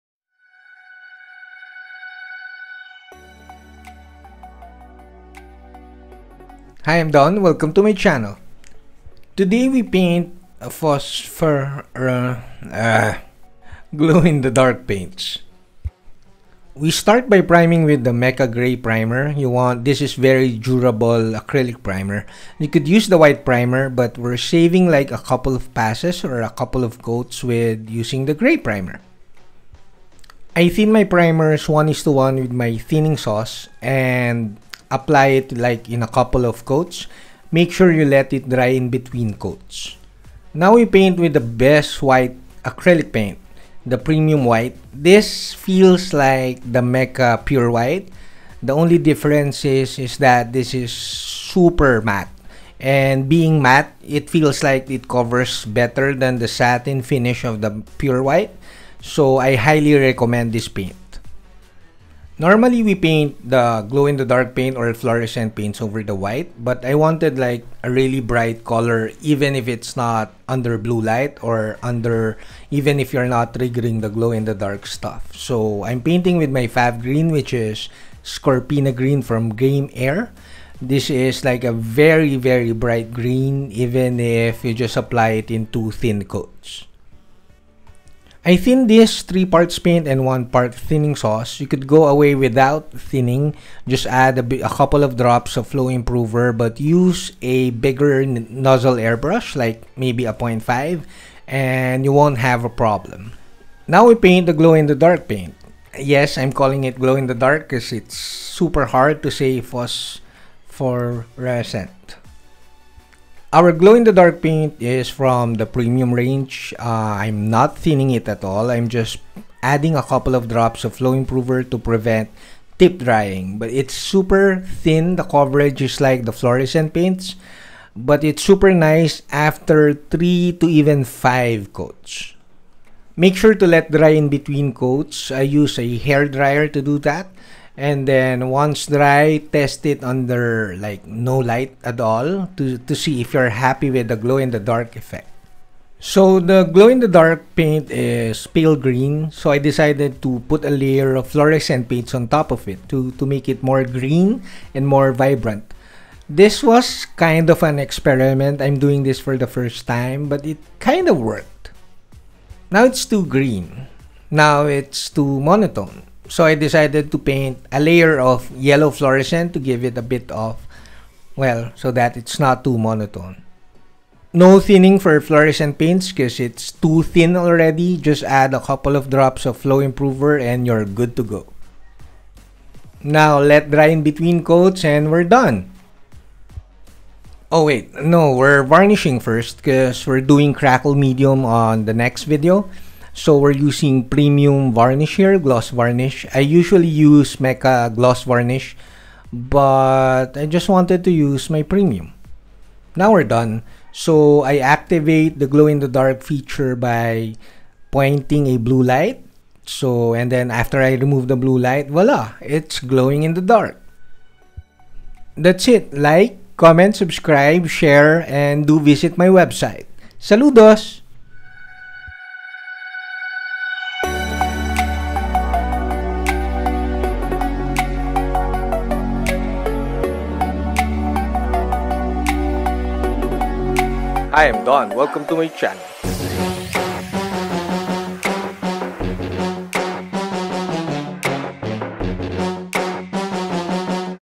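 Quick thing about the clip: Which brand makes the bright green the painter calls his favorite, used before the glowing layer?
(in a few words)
Game Air.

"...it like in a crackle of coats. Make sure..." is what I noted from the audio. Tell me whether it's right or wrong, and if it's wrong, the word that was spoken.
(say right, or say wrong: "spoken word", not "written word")
wrong: "couple", not "crackle".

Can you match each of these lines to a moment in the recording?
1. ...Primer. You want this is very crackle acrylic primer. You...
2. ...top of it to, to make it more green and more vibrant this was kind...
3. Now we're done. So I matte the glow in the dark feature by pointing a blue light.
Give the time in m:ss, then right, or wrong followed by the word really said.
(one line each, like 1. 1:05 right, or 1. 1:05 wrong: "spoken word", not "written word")
1. 0:18 wrong: "durable", not "crackle"
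2. 2:32 right
3. 3:22 wrong: "activate", not "matte".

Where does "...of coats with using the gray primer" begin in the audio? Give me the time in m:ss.
0:26.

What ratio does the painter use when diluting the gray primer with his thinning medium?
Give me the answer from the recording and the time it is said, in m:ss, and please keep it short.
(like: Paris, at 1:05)
1 to 1, at 0:31.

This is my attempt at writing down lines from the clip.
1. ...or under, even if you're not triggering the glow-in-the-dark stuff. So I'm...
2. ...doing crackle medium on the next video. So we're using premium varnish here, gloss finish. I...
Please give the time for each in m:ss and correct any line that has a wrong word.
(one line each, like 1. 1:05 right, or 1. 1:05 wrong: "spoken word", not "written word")
1. 1:11 right
2. 3:10 wrong: "varnish", not "finish".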